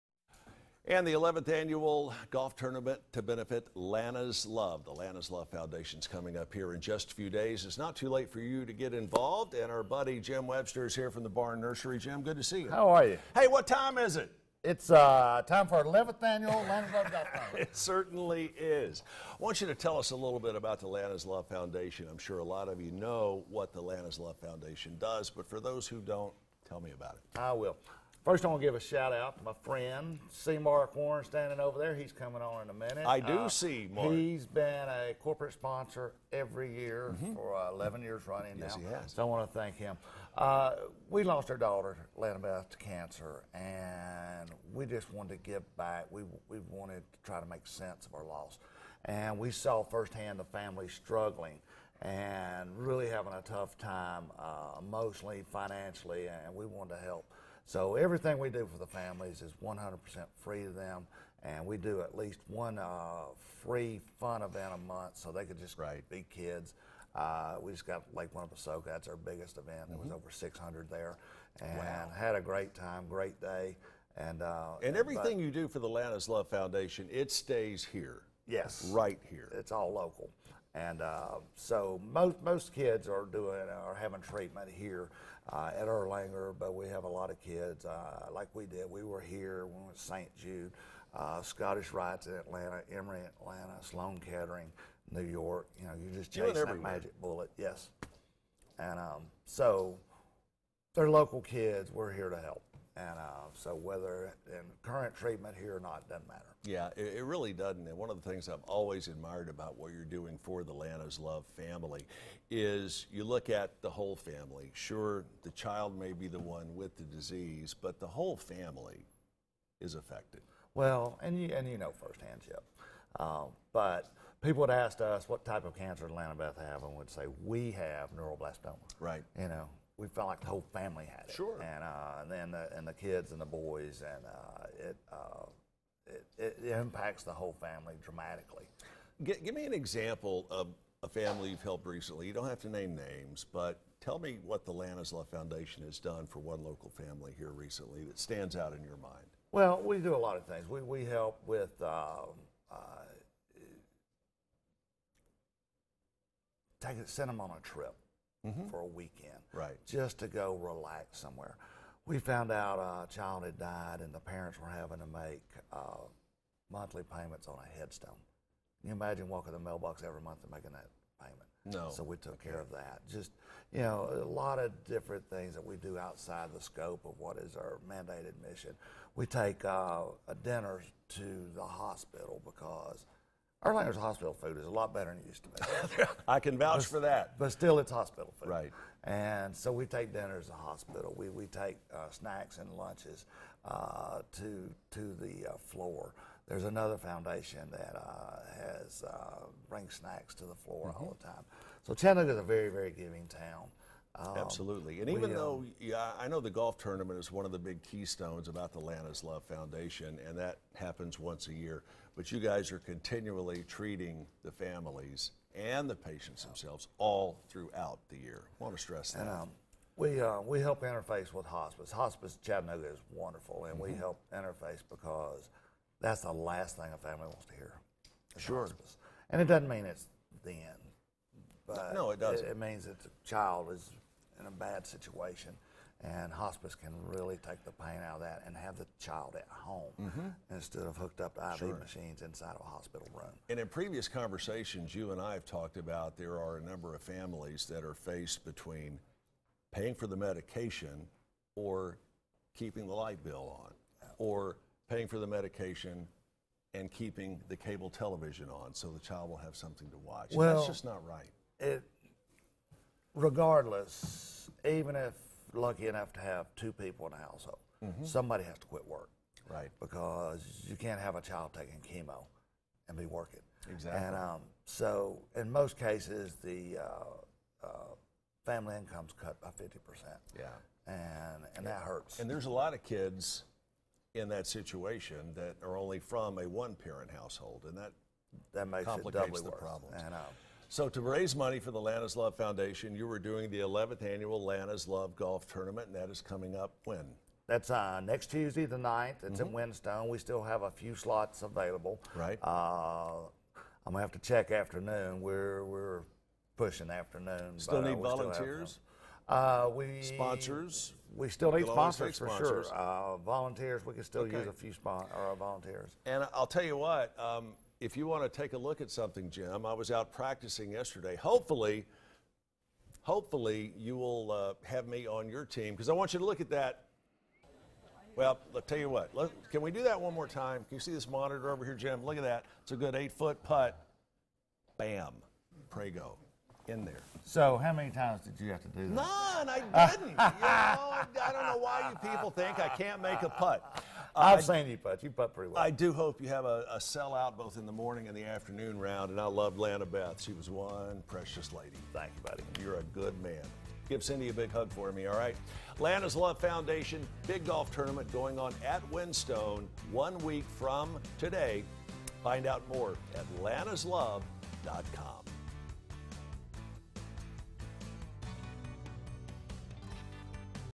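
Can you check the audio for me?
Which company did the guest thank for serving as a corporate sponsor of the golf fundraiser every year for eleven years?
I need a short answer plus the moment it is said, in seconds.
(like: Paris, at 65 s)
Barn Nursery, at 11 s.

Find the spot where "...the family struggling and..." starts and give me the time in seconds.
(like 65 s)
50 s.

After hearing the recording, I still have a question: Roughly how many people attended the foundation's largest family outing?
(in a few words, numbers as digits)
over 600.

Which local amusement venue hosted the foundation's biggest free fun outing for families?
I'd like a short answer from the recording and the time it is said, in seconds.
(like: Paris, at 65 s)
Lake Winnepesaukah, at 68 s.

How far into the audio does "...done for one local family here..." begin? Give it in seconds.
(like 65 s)
145 s.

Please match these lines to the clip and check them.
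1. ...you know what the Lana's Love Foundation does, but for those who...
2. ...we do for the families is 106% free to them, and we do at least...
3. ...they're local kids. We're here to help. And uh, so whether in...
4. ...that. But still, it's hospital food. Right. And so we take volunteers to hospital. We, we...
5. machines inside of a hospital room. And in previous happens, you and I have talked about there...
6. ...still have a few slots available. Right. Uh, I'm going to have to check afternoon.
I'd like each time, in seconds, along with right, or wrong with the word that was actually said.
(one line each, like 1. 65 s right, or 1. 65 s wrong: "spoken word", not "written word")
1. 22 s right
2. 58 s wrong: "100", not "106"
3. 100 s right
4. 187 s wrong: "dinners", not "volunteers"
5. 241 s wrong: "conversations", not "happens"
6. 300 s right.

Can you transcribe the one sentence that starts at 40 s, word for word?
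Uh, we lost our daughter, Lanabeth, to cancer, and we just wanted to give back.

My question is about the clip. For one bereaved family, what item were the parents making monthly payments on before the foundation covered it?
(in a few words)
A headstone.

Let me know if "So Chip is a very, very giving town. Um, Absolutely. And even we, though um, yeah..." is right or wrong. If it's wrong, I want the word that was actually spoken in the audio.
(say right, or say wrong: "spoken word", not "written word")
wrong: "Chattanooga", not "Chip".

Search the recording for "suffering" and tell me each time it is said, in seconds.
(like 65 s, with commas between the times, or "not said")
not said.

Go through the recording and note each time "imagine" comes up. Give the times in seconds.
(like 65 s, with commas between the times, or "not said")
168 s.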